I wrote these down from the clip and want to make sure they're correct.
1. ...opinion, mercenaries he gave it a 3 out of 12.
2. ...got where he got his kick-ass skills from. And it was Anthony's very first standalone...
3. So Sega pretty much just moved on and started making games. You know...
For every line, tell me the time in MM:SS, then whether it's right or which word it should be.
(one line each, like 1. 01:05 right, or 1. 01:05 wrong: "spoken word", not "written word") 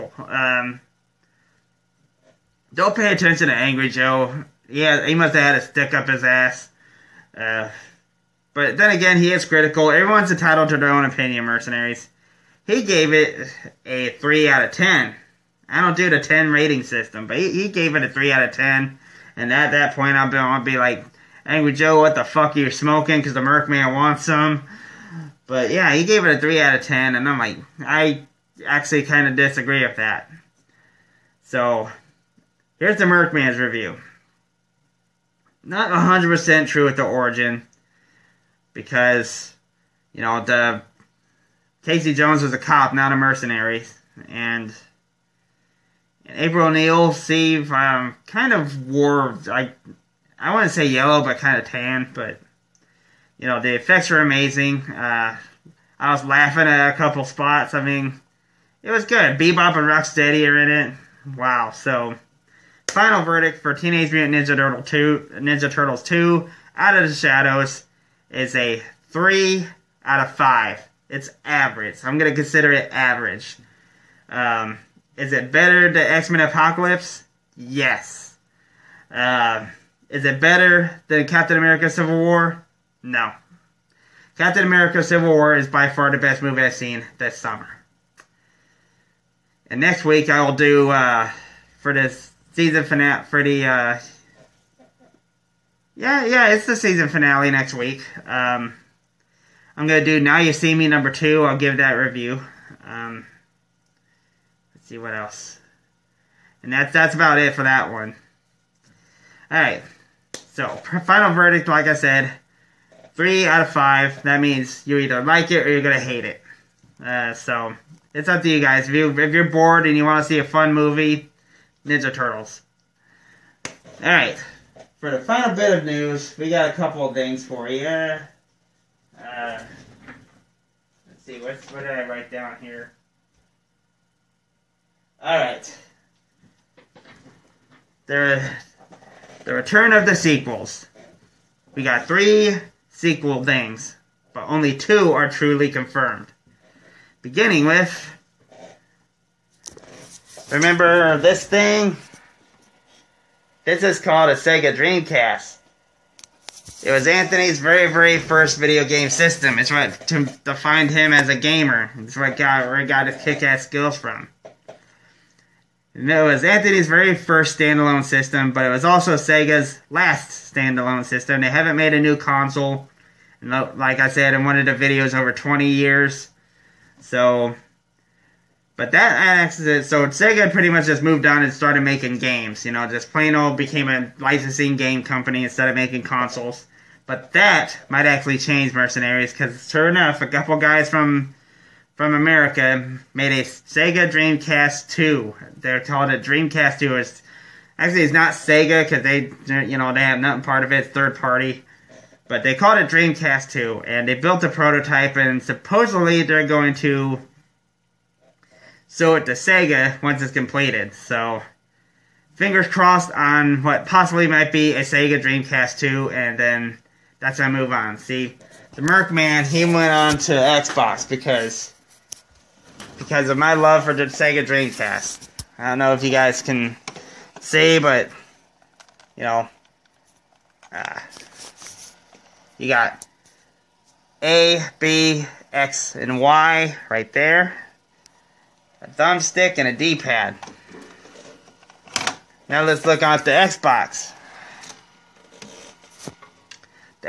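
1. 00:11 wrong: "10", not "12"
2. 02:42 right
3. 02:59 right.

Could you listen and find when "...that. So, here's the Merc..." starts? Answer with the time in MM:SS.
00:29.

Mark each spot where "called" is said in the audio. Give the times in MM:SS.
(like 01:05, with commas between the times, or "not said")
02:34, 03:15, 03:22.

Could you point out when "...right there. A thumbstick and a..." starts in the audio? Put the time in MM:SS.
03:56.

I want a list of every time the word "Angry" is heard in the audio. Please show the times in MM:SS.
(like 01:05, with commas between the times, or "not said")
00:03, 00:21.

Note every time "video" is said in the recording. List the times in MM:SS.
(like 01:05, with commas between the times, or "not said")
02:38, 02:54.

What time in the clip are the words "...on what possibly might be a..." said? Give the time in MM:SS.
03:33.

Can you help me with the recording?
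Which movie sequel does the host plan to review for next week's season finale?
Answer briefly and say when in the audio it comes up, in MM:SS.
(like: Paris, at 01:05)
Now You See Me 2, at 01:40.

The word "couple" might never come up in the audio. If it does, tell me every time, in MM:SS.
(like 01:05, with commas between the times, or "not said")
00:56, 02:06, 03:10.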